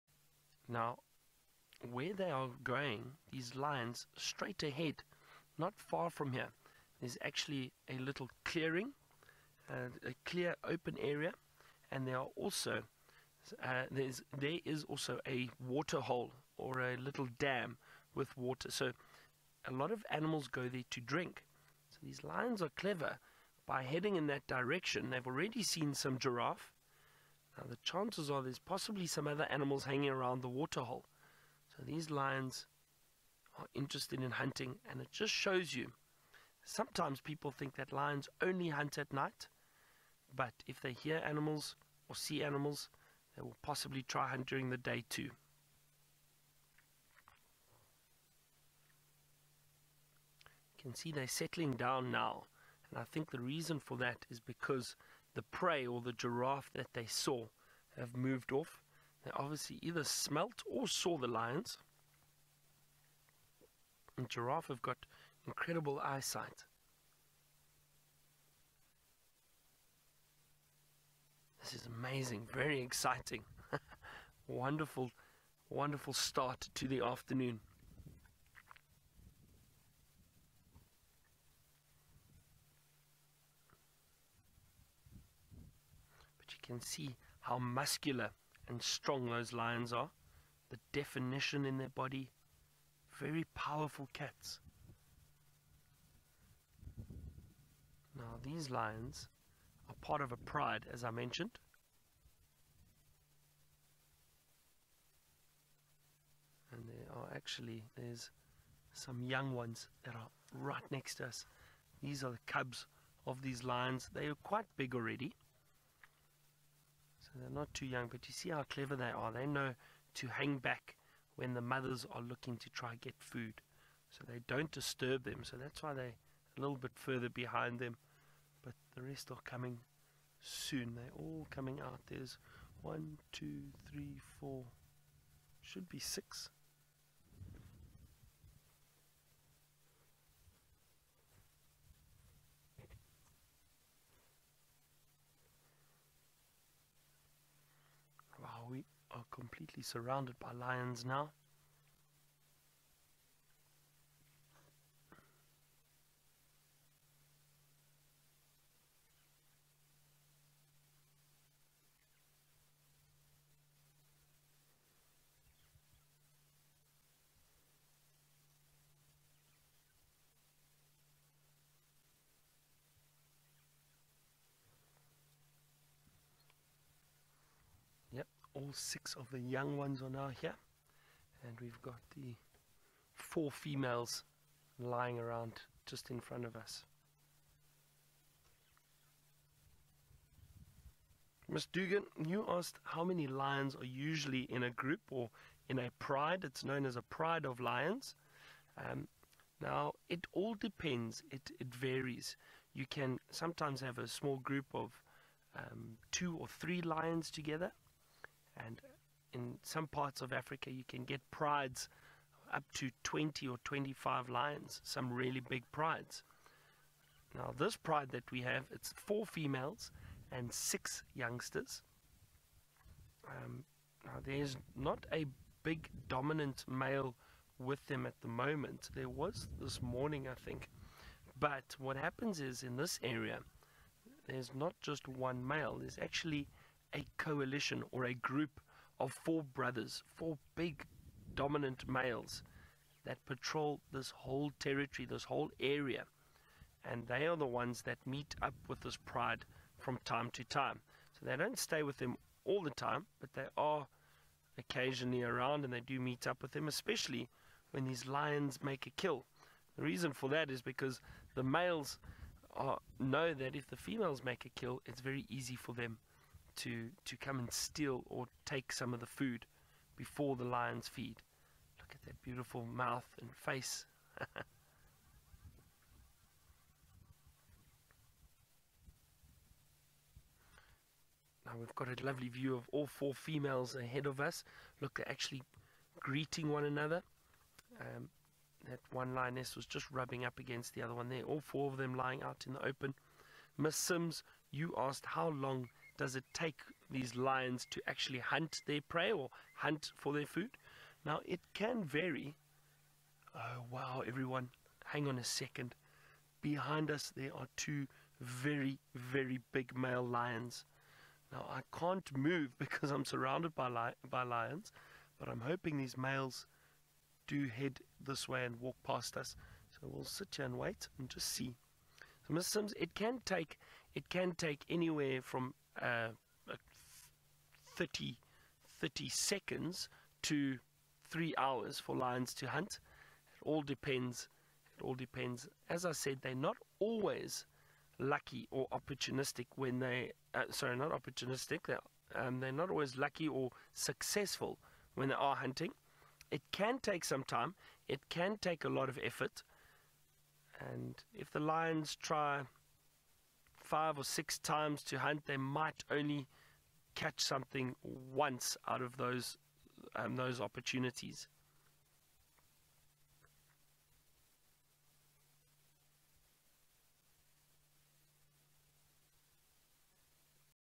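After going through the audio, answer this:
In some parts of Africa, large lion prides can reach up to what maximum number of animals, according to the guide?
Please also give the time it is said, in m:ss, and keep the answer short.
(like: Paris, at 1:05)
25, at 3:33.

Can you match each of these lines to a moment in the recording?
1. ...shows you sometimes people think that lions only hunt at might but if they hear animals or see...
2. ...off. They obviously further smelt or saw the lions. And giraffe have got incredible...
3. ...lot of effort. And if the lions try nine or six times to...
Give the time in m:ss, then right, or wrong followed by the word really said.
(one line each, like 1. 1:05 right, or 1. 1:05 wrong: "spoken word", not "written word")
1. 0:35 wrong: "night", not "might"
2. 0:58 wrong: "either", not "further"
3. 5:48 wrong: "five", not "nine".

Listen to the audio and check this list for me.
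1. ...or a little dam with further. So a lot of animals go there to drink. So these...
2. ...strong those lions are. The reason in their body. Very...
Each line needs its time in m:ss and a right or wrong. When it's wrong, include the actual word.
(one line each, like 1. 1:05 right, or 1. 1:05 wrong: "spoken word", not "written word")
1. 0:16 wrong: "water", not "further"
2. 1:28 wrong: "definition", not "reason".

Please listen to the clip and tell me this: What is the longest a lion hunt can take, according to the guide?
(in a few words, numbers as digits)
3 hours.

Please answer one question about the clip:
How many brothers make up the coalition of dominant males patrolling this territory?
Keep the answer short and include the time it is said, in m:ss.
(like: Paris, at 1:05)
4, at 3:59.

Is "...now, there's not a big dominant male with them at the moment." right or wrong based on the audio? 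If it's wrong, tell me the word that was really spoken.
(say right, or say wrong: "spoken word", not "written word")
right.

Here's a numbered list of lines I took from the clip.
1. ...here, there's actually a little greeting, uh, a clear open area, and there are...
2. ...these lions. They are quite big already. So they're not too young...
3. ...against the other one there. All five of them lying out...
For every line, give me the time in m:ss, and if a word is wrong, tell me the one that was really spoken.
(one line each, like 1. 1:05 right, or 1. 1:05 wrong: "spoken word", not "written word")
1. 0:06 wrong: "clearing", not "greeting"
2. 1:53 right
3. 4:50 wrong: "four", not "five".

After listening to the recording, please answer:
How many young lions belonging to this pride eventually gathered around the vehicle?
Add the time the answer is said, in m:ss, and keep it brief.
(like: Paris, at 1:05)
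6, at 2:58.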